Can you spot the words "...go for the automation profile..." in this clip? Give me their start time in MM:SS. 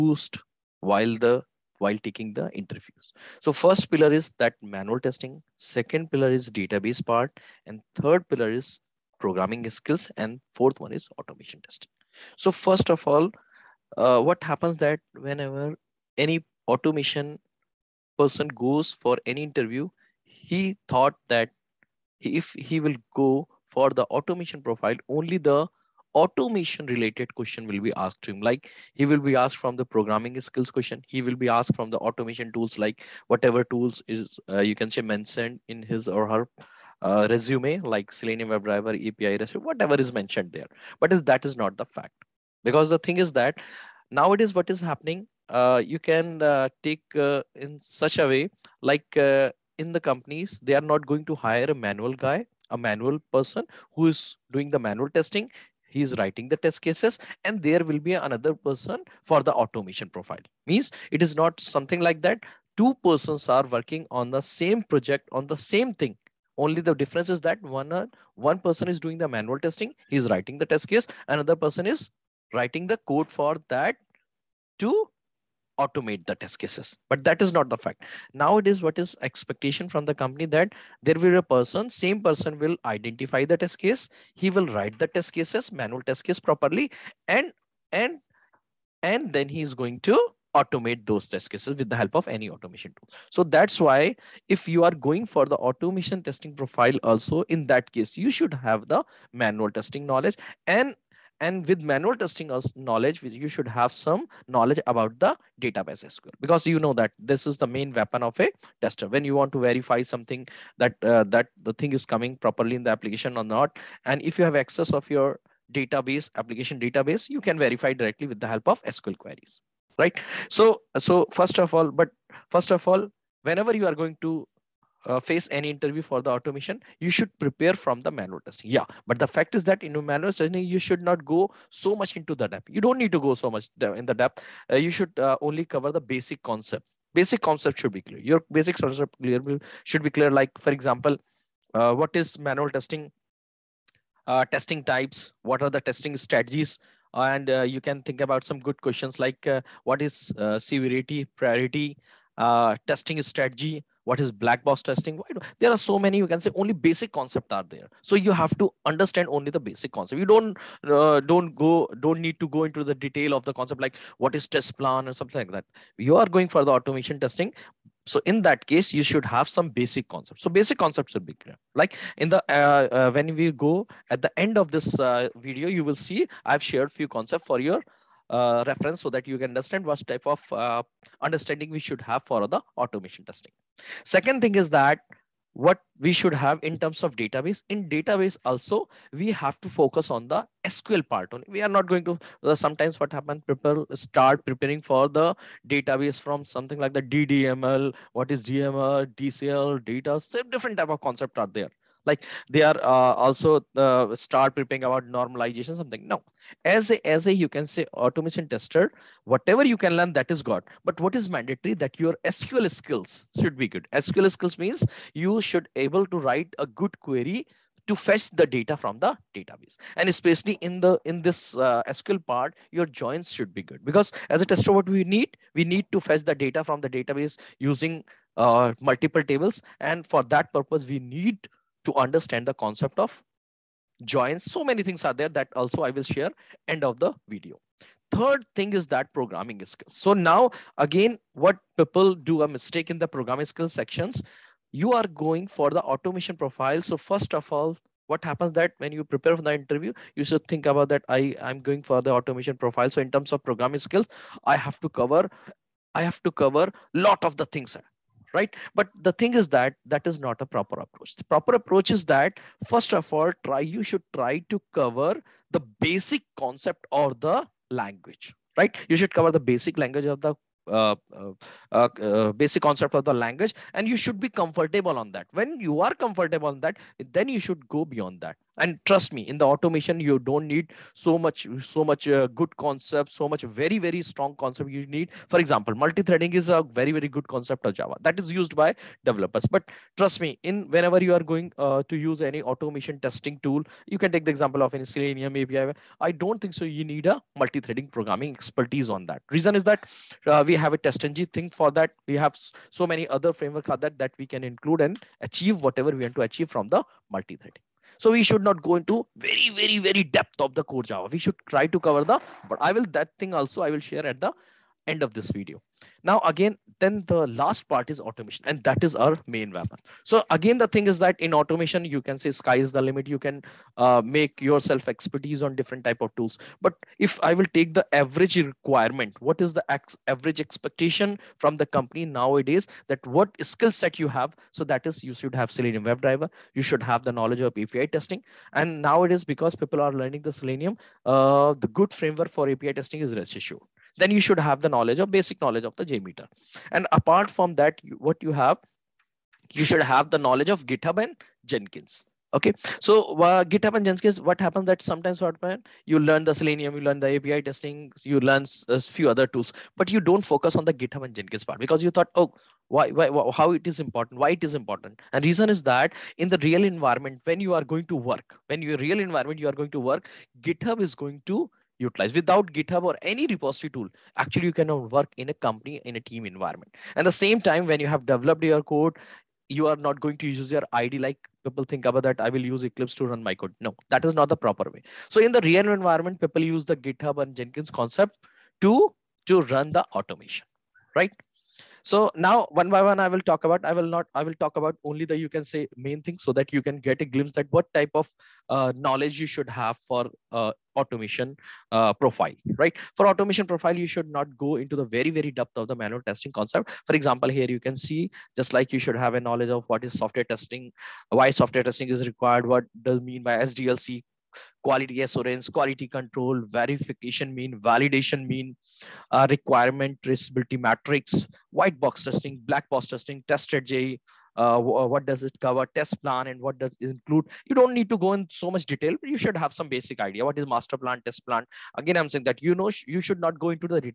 00:23.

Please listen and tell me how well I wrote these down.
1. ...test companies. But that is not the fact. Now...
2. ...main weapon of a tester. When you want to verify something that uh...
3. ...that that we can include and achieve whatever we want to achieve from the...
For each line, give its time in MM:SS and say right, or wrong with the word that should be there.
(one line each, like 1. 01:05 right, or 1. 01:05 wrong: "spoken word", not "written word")
1. 01:16 wrong: "cases", not "companies"
2. 01:47 right
3. 05:03 right.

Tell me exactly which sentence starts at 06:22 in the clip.
I will use Eclipse to run my code.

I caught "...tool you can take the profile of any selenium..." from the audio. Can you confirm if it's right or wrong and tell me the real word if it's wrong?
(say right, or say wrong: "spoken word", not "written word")
wrong: "example", not "profile".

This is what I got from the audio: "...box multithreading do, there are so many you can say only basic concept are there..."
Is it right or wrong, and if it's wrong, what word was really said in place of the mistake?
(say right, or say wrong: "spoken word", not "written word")
wrong: "testing", not "multithreading".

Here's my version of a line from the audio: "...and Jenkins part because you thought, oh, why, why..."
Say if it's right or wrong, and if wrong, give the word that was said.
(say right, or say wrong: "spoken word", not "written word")
right.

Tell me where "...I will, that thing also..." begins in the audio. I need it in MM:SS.
05:12.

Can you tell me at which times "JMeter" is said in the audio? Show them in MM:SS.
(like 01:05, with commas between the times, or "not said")
05:45.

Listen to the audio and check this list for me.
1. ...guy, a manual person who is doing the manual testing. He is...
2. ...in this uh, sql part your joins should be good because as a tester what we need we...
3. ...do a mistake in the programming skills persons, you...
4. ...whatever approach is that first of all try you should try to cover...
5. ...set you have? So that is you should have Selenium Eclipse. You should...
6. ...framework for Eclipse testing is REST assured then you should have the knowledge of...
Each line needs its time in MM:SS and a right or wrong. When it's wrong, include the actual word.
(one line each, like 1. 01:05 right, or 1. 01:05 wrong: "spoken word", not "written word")
1. 00:52 right
2. 03:41 right
3. 04:02 wrong: "sections", not "persons"
4. 04:21 wrong: "proper", not "whatever"
5. 05:33 wrong: "WebDriver", not "Eclipse"
6. 05:41 wrong: "API", not "Eclipse".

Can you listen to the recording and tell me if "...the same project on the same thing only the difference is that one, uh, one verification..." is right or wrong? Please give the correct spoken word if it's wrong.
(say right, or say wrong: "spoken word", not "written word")
wrong: "person", not "verification".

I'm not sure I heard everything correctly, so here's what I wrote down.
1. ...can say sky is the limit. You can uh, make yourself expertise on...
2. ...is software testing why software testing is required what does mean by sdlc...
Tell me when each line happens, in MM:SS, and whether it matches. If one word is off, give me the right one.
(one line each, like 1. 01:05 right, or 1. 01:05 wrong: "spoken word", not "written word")
1. 05:22 right
2. 06:49 right.